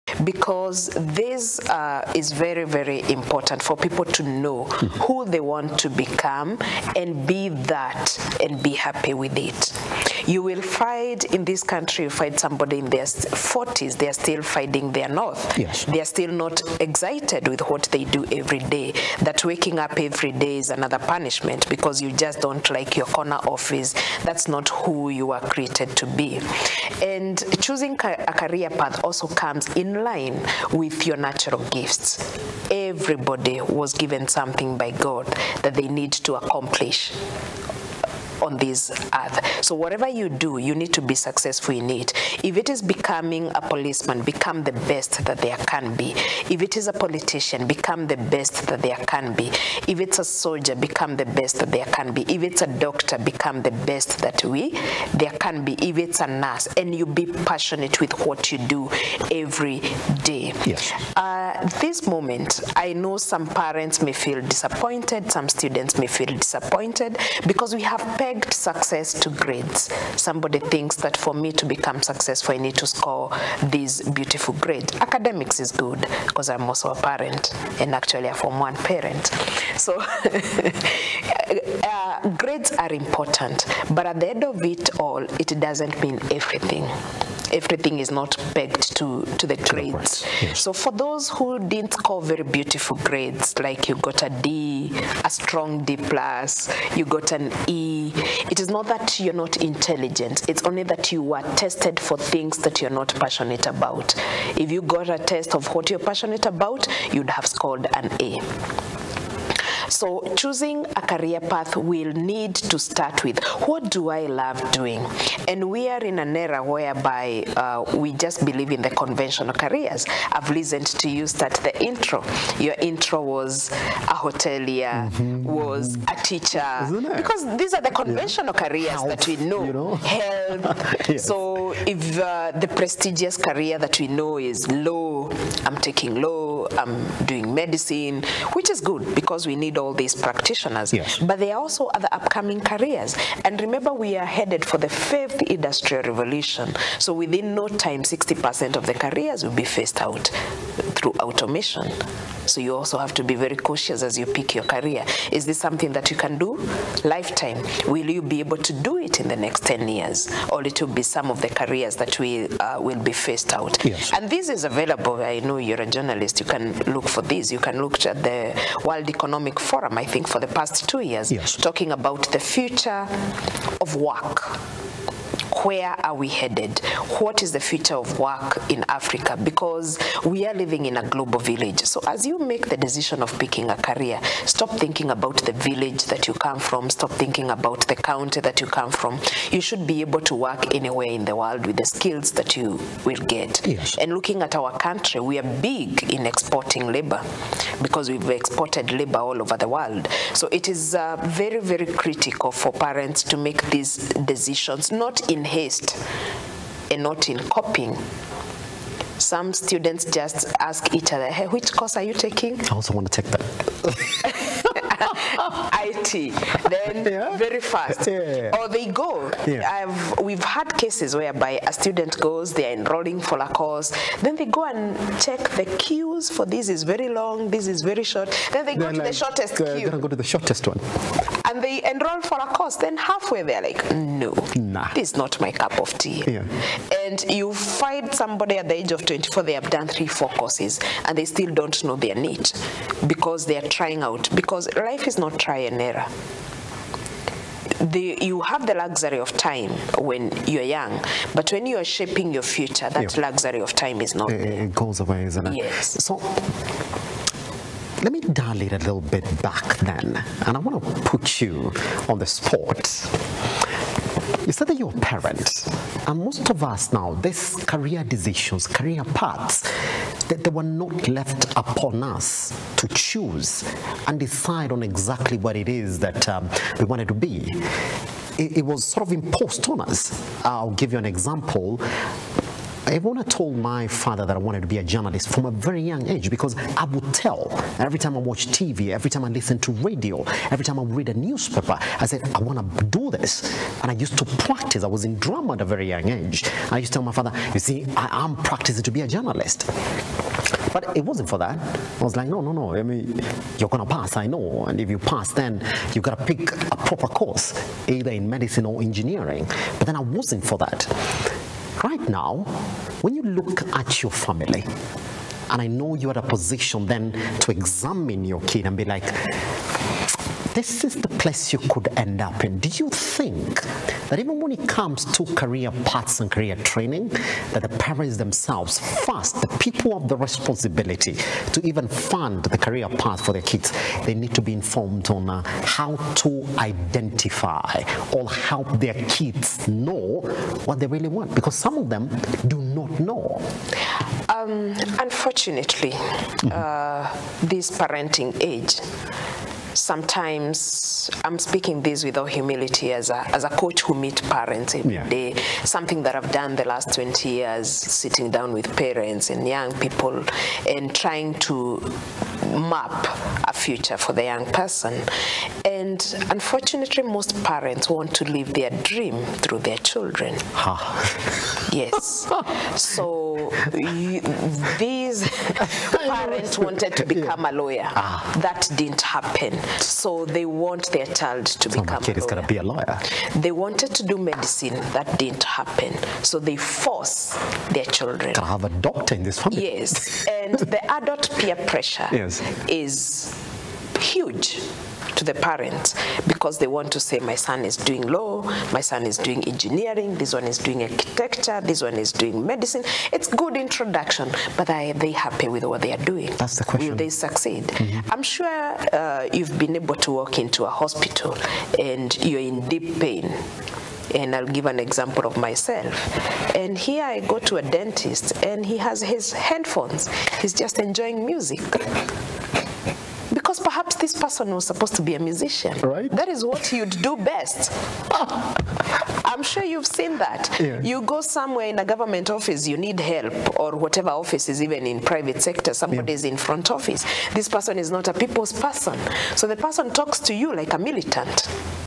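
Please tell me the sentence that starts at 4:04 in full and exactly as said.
Because life is not try and error.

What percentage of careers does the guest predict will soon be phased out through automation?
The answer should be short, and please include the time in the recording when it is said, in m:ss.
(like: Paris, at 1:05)
60%, at 2:28.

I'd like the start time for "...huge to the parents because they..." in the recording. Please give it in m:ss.
6:33.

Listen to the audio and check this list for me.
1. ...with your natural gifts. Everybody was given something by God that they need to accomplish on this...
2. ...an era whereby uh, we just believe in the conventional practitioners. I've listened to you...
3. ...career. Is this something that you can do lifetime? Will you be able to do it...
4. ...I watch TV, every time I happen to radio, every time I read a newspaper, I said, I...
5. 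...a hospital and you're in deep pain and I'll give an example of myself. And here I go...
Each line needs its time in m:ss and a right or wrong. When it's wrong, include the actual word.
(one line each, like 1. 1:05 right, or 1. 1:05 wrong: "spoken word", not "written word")
1. 0:30 right
2. 1:56 wrong: "careers", not "practitioners"
3. 2:34 right
4. 4:48 wrong: "listen", not "happen"
5. 6:50 right.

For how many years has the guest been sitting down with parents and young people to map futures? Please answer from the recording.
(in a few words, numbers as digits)
20.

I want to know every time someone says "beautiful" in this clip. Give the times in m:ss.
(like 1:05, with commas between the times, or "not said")
1:14, 1:32.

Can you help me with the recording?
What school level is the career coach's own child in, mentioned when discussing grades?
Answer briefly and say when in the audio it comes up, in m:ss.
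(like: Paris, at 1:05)
Form 1, at 1:18.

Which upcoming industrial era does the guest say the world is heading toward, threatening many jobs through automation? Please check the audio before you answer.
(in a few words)
fifth industrial revolution.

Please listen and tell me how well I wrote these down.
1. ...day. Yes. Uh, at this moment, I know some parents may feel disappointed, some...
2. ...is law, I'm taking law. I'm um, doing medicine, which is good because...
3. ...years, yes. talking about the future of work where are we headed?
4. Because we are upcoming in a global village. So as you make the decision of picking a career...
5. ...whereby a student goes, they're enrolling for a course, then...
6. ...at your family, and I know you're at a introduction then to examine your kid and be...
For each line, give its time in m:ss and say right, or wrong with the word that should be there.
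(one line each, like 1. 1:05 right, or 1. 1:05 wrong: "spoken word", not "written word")
1. 1:00 right
2. 2:14 right
3. 2:51 right
4. 2:59 wrong: "living", not "upcoming"
5. 3:41 right
6. 5:13 wrong: "position", not "introduction".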